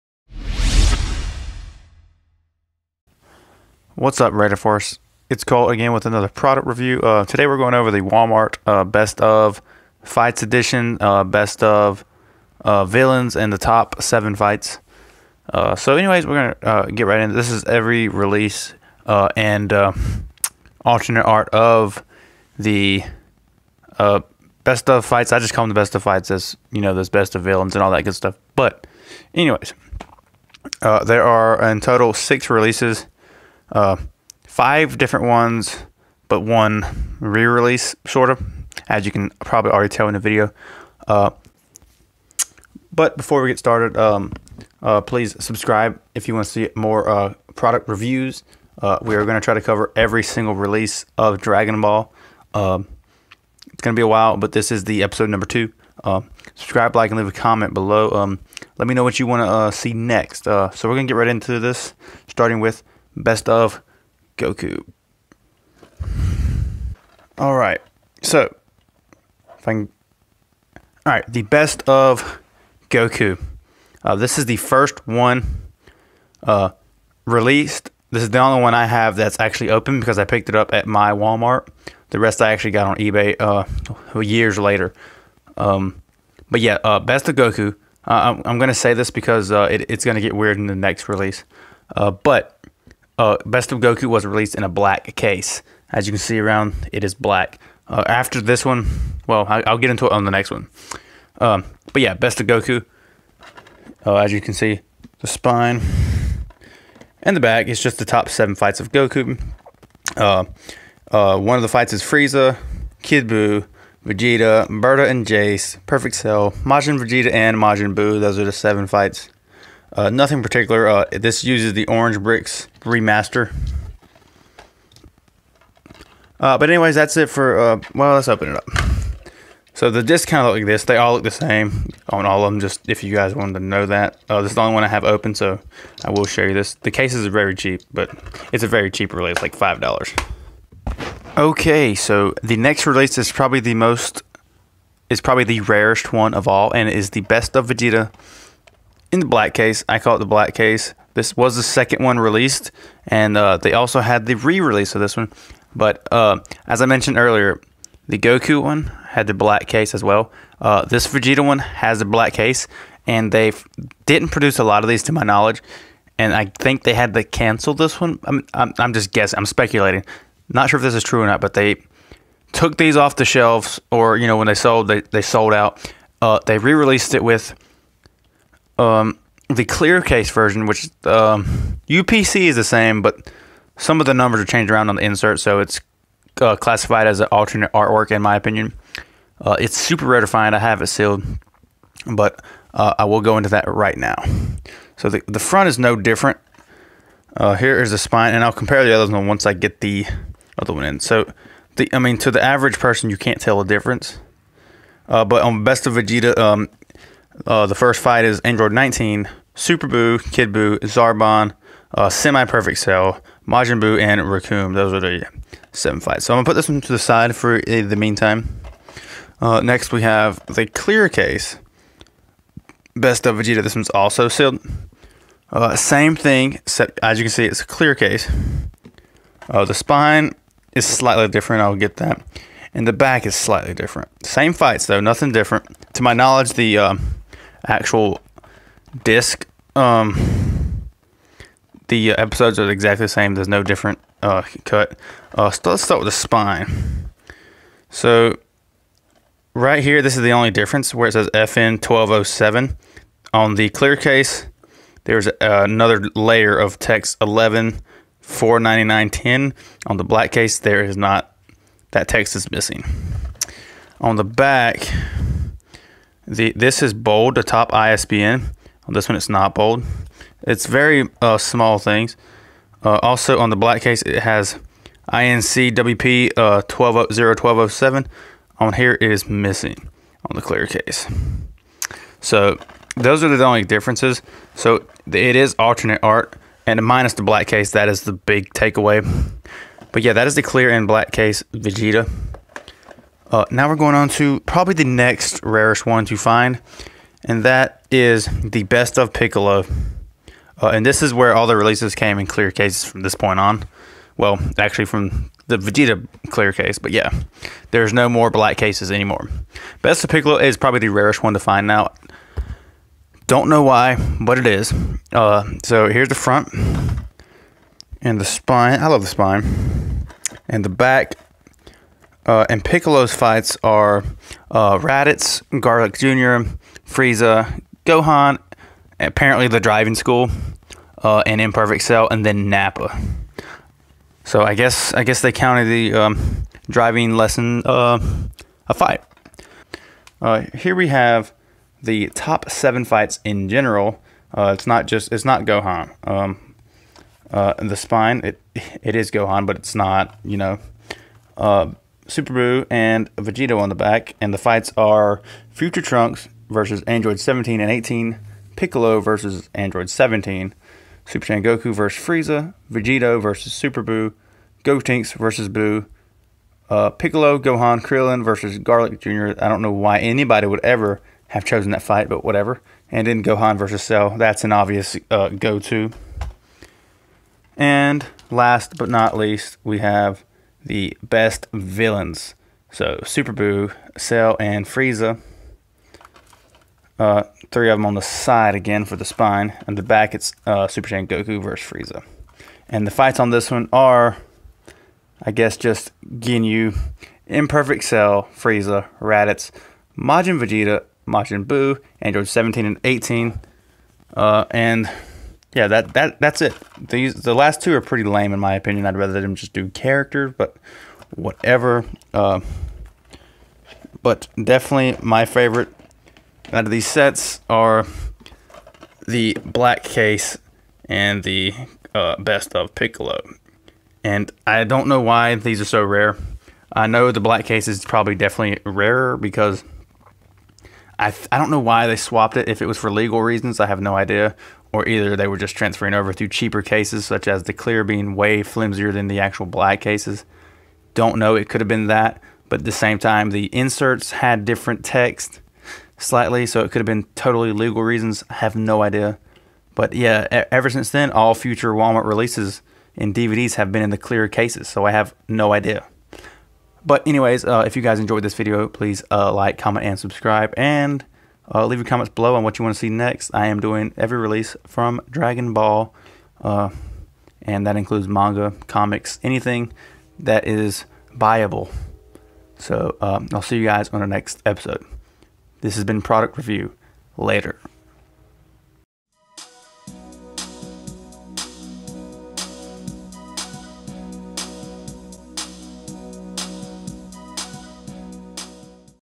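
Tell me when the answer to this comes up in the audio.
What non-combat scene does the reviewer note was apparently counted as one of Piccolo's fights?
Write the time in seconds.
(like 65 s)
329 s.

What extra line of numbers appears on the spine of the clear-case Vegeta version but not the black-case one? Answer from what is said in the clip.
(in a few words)
11 49910.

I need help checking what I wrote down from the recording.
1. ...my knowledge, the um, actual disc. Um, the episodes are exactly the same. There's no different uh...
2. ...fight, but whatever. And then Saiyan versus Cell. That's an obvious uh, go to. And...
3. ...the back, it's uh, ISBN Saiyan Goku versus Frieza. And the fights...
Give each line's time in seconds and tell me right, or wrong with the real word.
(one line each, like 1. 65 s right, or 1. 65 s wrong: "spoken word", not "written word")
1. 236 s right
2. 371 s wrong: "Gohan", not "Saiyan"
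3. 389 s wrong: "Super", not "ISBN".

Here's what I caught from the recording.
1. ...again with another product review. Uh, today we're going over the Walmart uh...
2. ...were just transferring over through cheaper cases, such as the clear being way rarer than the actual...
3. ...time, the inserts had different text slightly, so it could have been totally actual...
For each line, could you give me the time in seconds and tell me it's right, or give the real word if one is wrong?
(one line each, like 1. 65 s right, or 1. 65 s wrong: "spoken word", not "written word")
1. 5 s right
2. 435 s wrong: "flimsier", not "rarer"
3. 442 s wrong: "legal", not "actual".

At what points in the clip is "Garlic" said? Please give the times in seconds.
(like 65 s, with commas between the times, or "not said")
325 s, 368 s.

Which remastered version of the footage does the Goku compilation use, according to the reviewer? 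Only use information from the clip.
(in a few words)
Orange Bricks.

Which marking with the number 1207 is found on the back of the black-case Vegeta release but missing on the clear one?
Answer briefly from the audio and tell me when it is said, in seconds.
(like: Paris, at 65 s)
INC WP 1207, at 275 s.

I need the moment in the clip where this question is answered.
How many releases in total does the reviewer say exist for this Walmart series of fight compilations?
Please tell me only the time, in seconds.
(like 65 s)
32 s.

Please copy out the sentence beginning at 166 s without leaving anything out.
And I think they had to cancel this one.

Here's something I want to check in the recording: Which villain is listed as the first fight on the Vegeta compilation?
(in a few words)
Android 19.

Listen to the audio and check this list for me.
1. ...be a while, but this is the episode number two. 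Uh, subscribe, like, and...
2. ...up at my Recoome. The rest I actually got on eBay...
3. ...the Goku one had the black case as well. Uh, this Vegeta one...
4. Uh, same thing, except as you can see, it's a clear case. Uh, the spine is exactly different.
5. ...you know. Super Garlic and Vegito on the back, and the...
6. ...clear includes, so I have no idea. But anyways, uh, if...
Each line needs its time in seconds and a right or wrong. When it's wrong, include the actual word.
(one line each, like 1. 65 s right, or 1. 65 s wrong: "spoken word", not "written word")
1. 53 s right
2. 80 s wrong: "Walmart", not "Recoome"
3. 158 s right
4. 225 s wrong: "slightly", not "exactly"
5. 350 s wrong: "Buu", not "Garlic"
6. 453 s wrong: "cases", not "includes".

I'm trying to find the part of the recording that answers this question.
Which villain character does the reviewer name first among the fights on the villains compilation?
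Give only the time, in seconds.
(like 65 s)
396 s.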